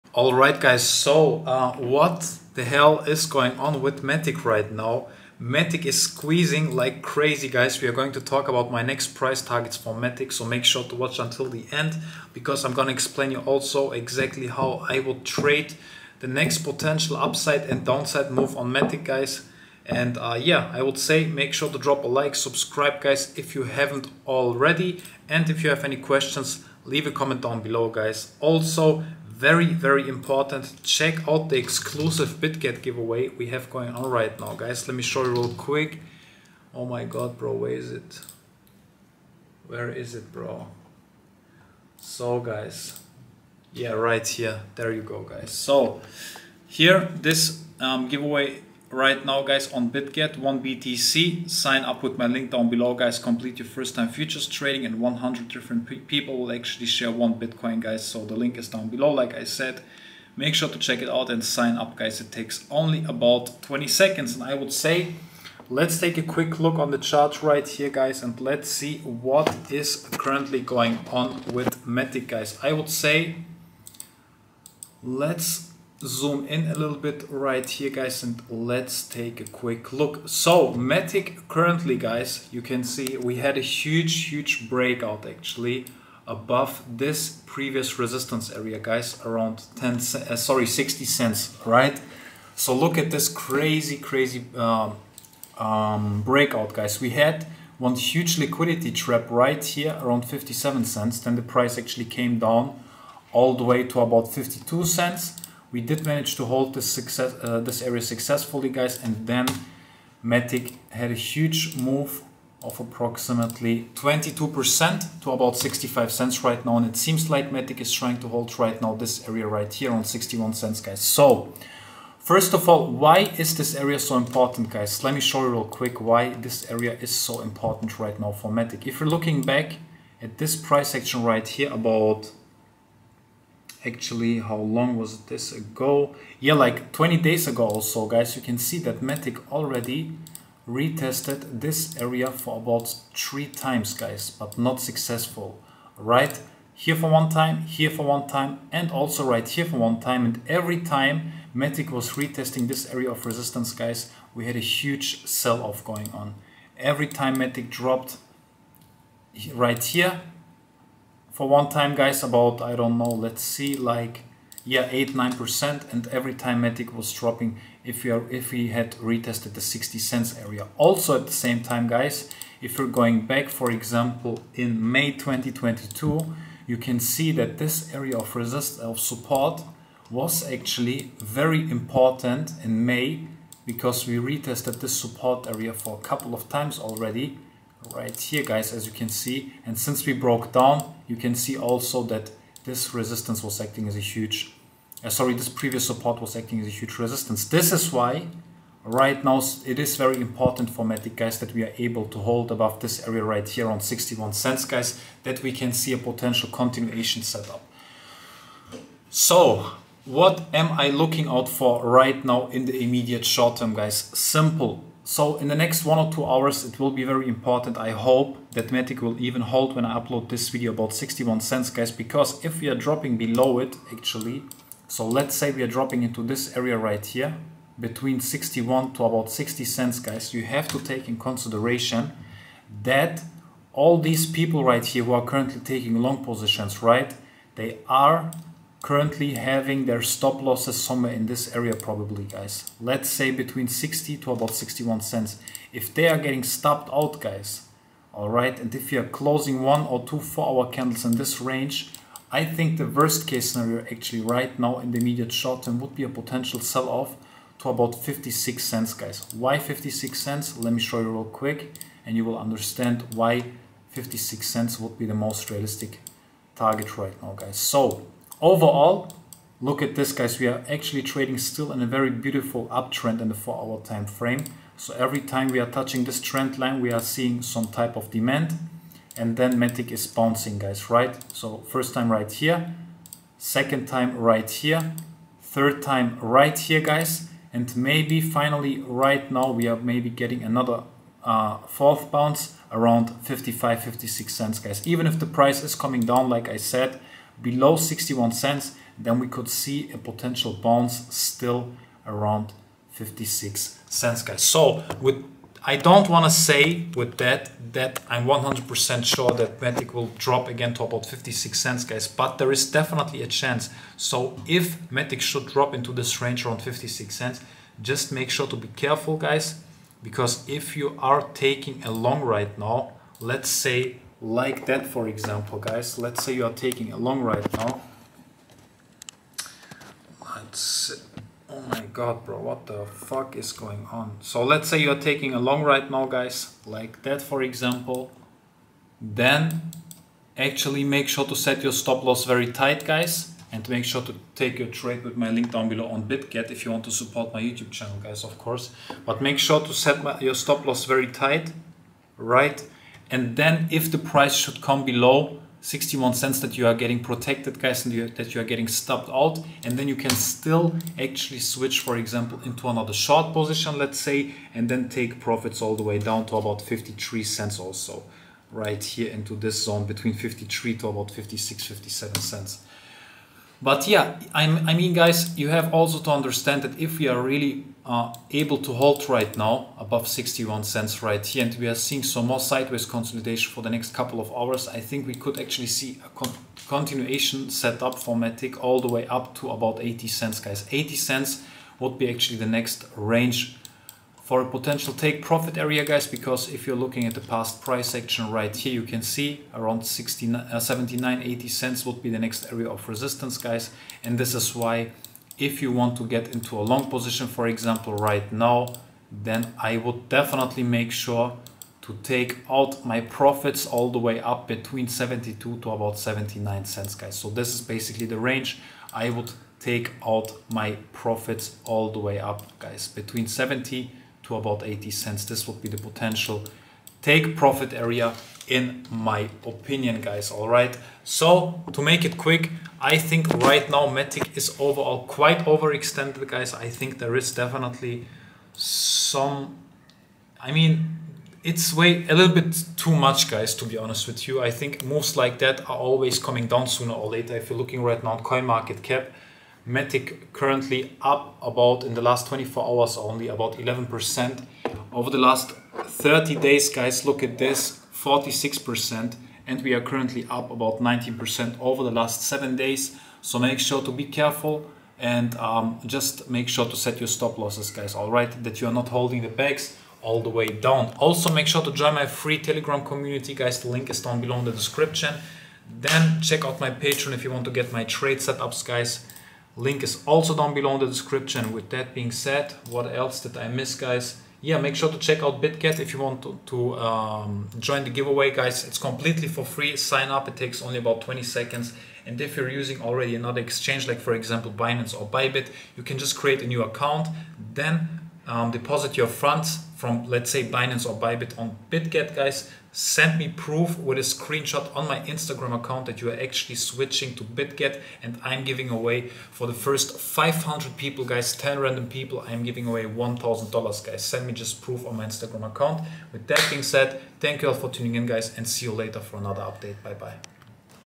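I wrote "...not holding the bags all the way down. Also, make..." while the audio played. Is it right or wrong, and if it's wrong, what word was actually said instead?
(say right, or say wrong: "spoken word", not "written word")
right.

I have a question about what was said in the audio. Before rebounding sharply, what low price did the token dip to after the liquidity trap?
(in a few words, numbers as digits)
52 cents.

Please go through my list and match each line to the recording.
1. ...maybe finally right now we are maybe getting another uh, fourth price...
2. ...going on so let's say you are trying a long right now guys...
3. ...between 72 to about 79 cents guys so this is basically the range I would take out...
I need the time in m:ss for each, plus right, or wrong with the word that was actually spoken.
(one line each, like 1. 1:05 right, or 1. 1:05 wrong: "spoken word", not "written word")
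1. 4:47 wrong: "bounce", not "price"
2. 5:33 wrong: "taking", not "trying"
3. 6:54 right.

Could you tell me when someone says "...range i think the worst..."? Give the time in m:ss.
4:11.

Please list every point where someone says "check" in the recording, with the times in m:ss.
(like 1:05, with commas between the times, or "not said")
0:30, 1:00, 7:56, 8:04.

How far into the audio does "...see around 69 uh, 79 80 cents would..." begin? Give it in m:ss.
6:39.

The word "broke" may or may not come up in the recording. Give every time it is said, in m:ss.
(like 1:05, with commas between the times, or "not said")
3:10.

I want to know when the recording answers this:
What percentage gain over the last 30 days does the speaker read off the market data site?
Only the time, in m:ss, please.
7:37.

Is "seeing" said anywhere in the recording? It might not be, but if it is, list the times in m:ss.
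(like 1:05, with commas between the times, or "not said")
4:36, 6:21.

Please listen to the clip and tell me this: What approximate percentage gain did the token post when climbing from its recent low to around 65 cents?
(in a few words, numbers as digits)
22%.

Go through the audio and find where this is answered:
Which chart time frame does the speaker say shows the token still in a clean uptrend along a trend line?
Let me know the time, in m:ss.
4:33.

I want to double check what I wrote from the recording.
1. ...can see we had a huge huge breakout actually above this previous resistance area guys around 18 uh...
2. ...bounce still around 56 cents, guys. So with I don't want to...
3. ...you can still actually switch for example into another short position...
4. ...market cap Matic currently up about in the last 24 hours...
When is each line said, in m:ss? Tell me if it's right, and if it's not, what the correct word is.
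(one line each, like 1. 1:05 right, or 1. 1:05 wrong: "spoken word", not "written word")
1. 1:22 wrong: "10", not "18"
2. 5:00 right
3. 5:59 right
4. 7:28 right.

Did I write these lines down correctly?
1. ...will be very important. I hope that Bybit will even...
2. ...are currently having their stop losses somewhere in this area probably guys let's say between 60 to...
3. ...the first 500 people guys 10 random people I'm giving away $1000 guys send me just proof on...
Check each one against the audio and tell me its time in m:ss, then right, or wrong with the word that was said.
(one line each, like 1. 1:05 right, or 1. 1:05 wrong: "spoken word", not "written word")
1. 3:36 wrong: "Matic", not "Bybit"
2. 3:57 right
3. 8:29 right.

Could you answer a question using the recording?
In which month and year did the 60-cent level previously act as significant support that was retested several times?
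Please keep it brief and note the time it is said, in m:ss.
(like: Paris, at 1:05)
May 2022, at 2:54.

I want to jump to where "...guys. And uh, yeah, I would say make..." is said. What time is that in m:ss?
0:19.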